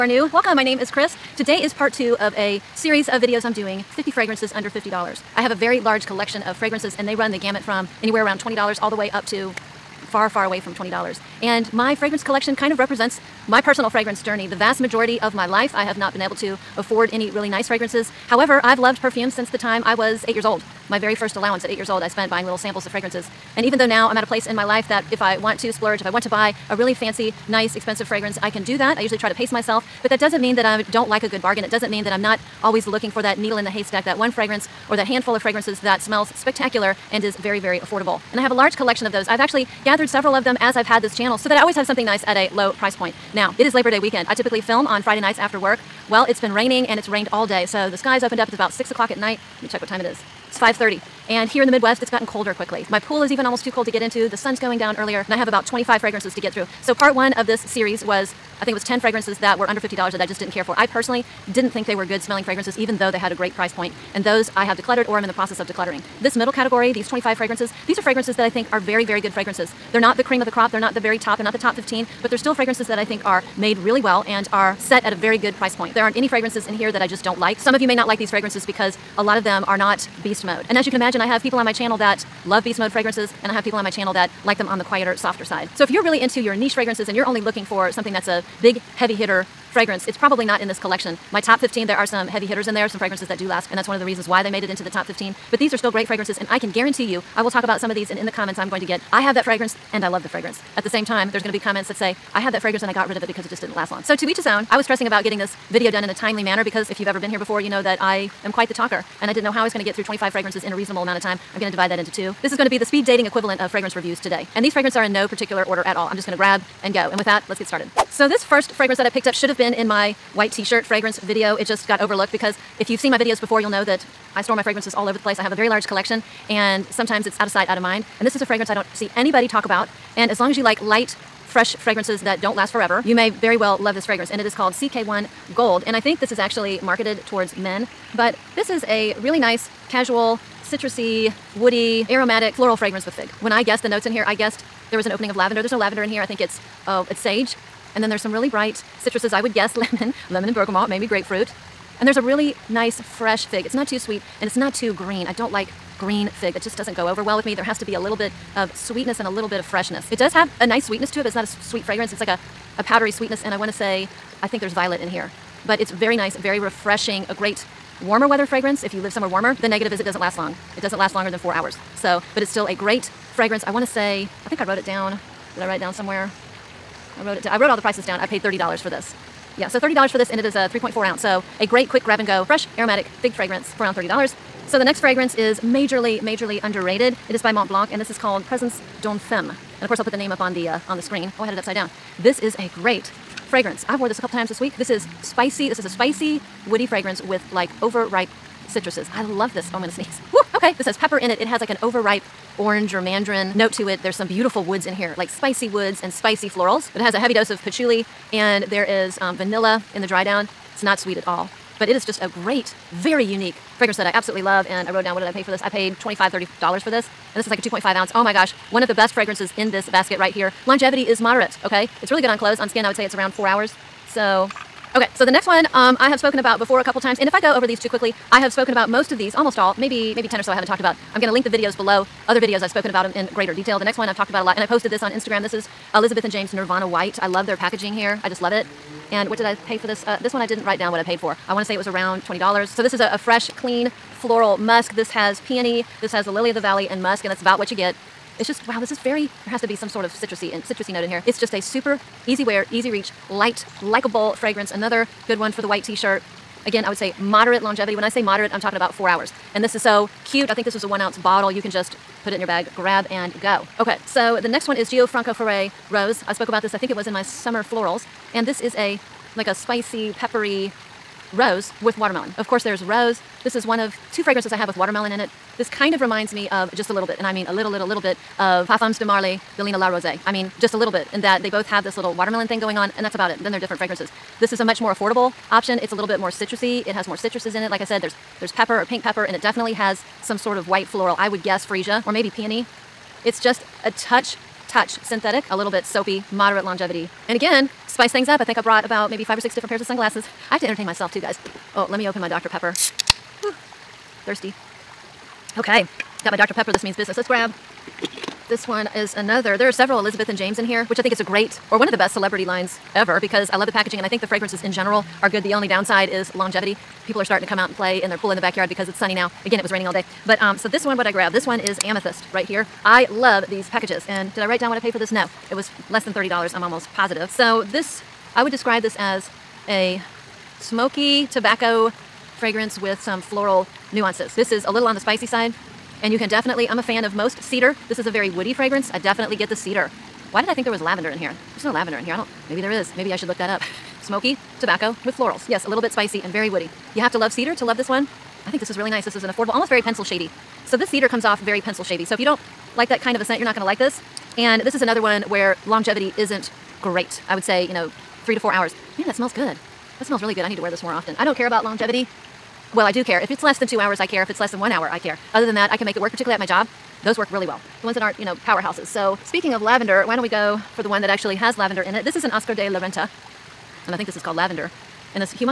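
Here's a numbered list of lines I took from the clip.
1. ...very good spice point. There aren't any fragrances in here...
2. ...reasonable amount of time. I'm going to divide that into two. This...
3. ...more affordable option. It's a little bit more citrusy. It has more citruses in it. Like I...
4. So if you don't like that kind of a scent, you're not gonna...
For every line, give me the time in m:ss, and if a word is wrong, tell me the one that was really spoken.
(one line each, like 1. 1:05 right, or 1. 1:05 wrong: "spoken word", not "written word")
1. 1:15 wrong: "price", not "spice"
2. 1:50 right
3. 4:44 right
4. 5:52 right.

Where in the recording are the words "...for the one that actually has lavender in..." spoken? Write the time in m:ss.
6:10.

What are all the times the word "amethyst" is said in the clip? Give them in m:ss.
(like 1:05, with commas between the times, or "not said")
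5:21.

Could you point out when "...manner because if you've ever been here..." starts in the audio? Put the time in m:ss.
1:46.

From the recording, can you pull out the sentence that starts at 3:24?
There's some beautiful woods in here, like spicy woods and spicy florals.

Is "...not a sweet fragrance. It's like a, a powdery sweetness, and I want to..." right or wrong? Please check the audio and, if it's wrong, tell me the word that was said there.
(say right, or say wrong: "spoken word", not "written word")
right.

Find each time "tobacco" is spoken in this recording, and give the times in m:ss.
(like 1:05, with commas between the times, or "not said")
5:31, 5:44.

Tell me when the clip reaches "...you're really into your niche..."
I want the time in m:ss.
1:25.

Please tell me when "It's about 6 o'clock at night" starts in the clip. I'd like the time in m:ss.
0:48.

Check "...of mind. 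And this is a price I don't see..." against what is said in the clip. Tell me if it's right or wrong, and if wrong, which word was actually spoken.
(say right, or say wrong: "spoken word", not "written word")
wrong: "fragrance", not "price".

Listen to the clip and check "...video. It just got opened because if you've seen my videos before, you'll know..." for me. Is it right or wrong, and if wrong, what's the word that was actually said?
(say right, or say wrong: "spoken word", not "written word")
wrong: "overlooked", not "opened".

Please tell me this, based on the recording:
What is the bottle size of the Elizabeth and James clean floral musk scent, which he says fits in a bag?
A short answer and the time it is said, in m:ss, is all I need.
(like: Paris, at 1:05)
1 ounce, at 4:20.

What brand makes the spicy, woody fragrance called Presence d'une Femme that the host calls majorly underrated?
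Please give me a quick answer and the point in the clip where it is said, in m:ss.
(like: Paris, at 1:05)
Mont Blanc, at 3:07.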